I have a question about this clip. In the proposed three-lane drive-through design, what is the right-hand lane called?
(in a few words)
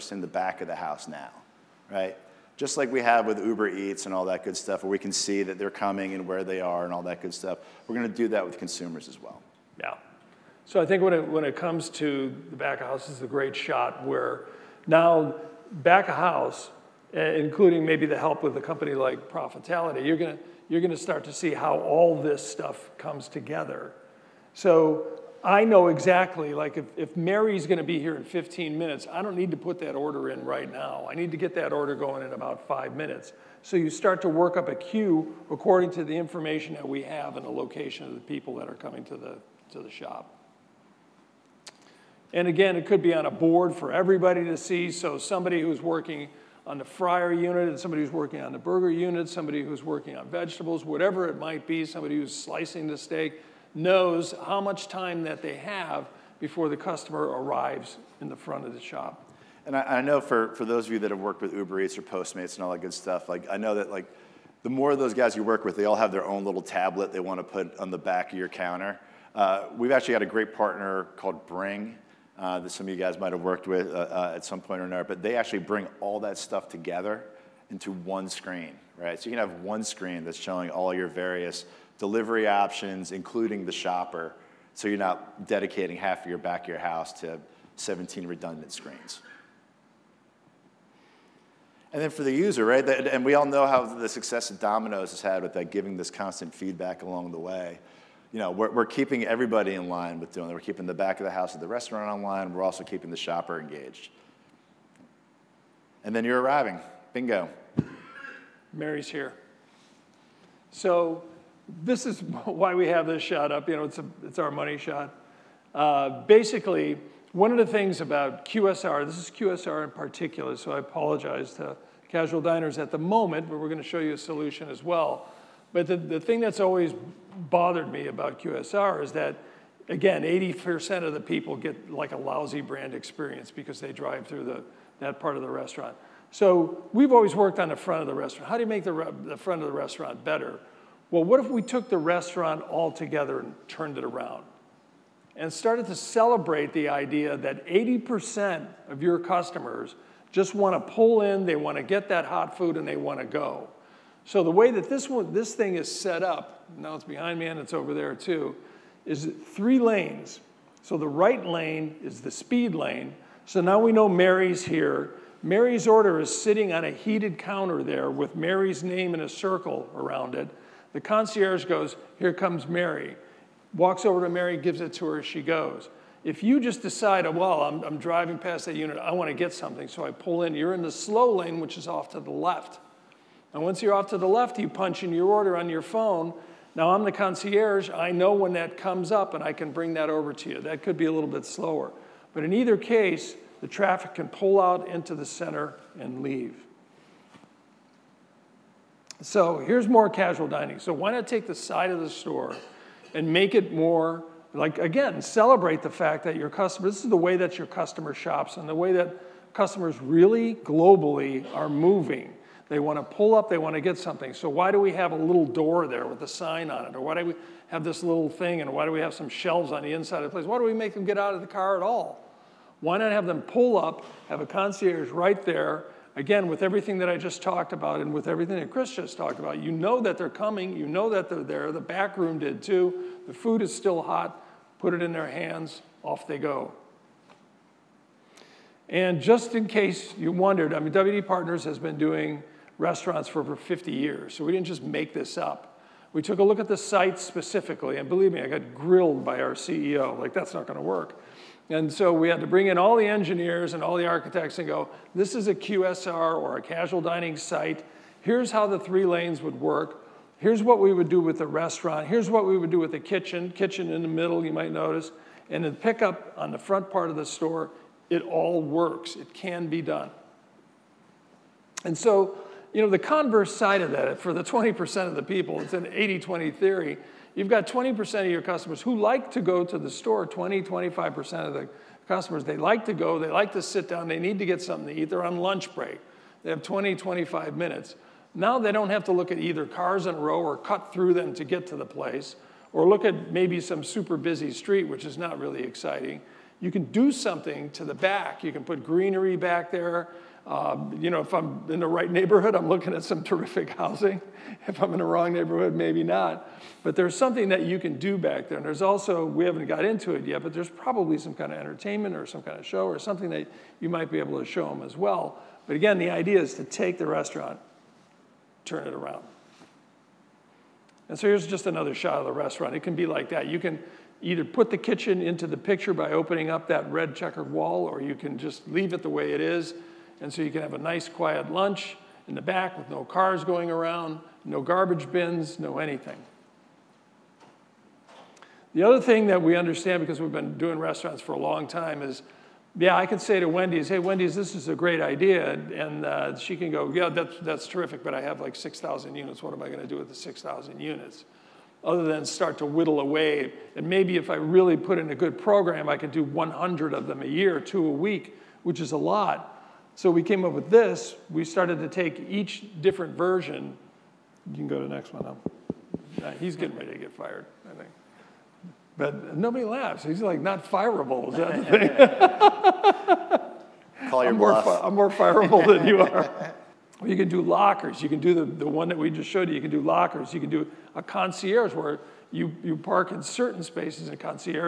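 speed lane.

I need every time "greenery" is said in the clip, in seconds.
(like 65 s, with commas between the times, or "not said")
298 s.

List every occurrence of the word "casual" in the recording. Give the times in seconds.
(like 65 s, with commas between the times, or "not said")
122 s, 200 s, 256 s.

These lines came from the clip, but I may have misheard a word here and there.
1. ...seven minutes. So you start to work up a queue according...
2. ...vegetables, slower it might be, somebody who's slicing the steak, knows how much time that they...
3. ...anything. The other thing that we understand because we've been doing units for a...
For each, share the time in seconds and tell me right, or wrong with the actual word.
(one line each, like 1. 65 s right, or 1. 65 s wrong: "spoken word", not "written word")
1. 32 s wrong: "five", not "seven"
2. 50 s wrong: "whatever", not "slower"
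3. 335 s wrong: "restaurants", not "units".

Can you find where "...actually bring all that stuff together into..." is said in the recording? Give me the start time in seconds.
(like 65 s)
75 s.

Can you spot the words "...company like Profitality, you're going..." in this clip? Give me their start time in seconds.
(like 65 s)
18 s.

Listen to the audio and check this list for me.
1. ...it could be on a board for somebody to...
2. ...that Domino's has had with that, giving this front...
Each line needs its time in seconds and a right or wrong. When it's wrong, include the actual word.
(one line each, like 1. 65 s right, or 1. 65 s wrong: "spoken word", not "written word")
1. 42 s wrong: "everybody", not "somebody"
2. 94 s wrong: "constant", not "front".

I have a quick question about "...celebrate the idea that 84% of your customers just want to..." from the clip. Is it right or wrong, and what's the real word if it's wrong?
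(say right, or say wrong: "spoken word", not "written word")
wrong: "80", not "84".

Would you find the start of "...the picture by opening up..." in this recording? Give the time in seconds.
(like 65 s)
325 s.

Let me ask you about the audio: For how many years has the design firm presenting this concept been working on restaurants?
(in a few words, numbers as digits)
over 50 years.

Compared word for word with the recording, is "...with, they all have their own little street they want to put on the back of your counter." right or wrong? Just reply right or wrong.
wrong.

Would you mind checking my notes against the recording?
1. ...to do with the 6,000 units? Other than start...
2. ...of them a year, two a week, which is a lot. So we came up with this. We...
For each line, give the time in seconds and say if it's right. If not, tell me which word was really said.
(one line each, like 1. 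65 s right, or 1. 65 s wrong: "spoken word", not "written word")
1. 349 s right
2. 356 s right.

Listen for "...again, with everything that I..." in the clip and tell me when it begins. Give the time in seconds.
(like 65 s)
226 s.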